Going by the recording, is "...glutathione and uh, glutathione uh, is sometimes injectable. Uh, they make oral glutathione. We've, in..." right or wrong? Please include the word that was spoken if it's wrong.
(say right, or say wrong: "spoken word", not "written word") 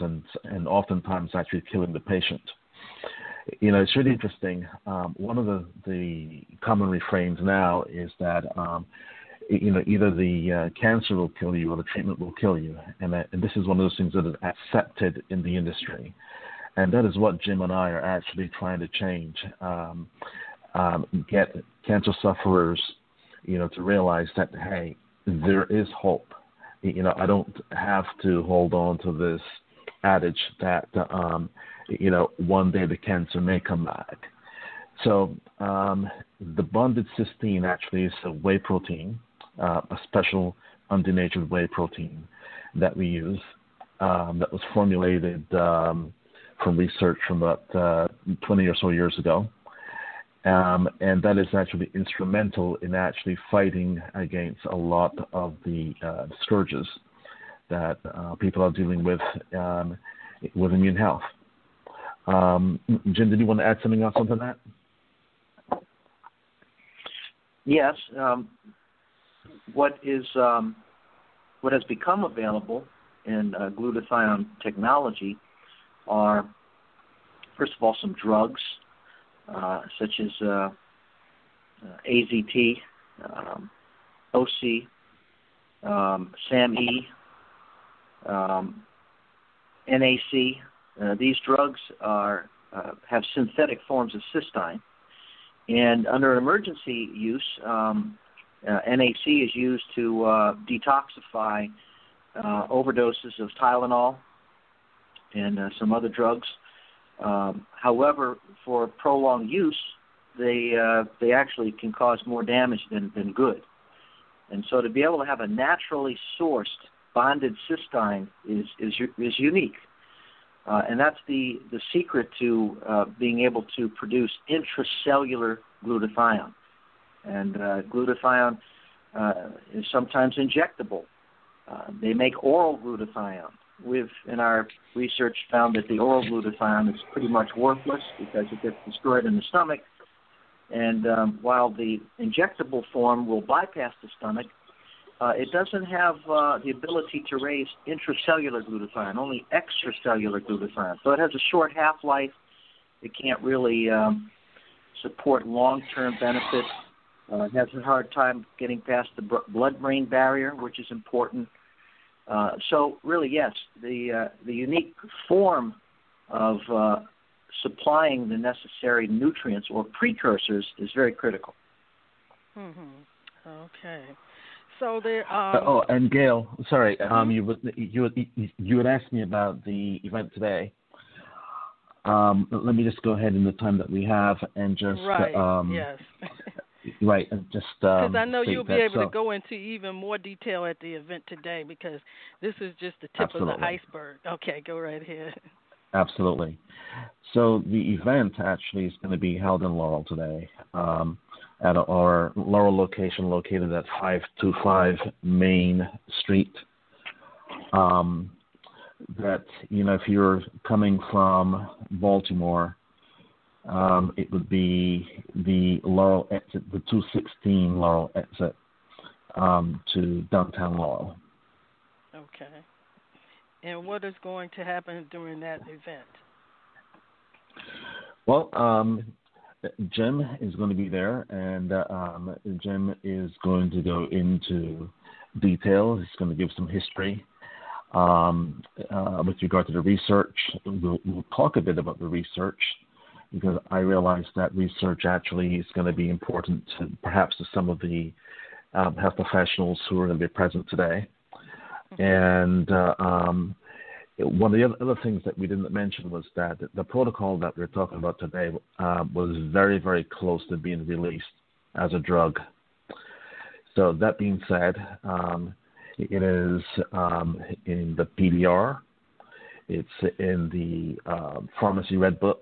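right.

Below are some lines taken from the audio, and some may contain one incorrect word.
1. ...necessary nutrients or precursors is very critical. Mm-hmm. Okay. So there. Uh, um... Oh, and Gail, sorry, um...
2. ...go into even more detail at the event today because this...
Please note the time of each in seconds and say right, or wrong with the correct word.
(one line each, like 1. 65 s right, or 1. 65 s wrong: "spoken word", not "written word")
1. 168 s right
2. 189 s right.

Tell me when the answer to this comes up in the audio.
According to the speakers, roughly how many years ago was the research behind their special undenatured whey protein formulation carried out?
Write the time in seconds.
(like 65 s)
48 s.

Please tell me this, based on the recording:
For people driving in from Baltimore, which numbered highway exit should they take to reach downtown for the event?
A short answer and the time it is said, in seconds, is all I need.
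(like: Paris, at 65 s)
216, at 216 s.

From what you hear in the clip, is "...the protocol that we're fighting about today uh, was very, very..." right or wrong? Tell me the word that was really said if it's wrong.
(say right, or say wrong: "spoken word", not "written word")
wrong: "talking", not "fighting".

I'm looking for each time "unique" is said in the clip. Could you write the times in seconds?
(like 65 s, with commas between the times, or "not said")
119 s, 164 s.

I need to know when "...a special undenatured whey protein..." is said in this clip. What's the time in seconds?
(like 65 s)
39 s.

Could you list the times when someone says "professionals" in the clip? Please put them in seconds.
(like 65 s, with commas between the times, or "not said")
249 s.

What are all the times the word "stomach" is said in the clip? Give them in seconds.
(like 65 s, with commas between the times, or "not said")
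139 s, 144 s.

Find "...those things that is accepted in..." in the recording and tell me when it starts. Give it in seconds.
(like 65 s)
13 s.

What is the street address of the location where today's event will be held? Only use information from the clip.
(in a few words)
525 Main Street.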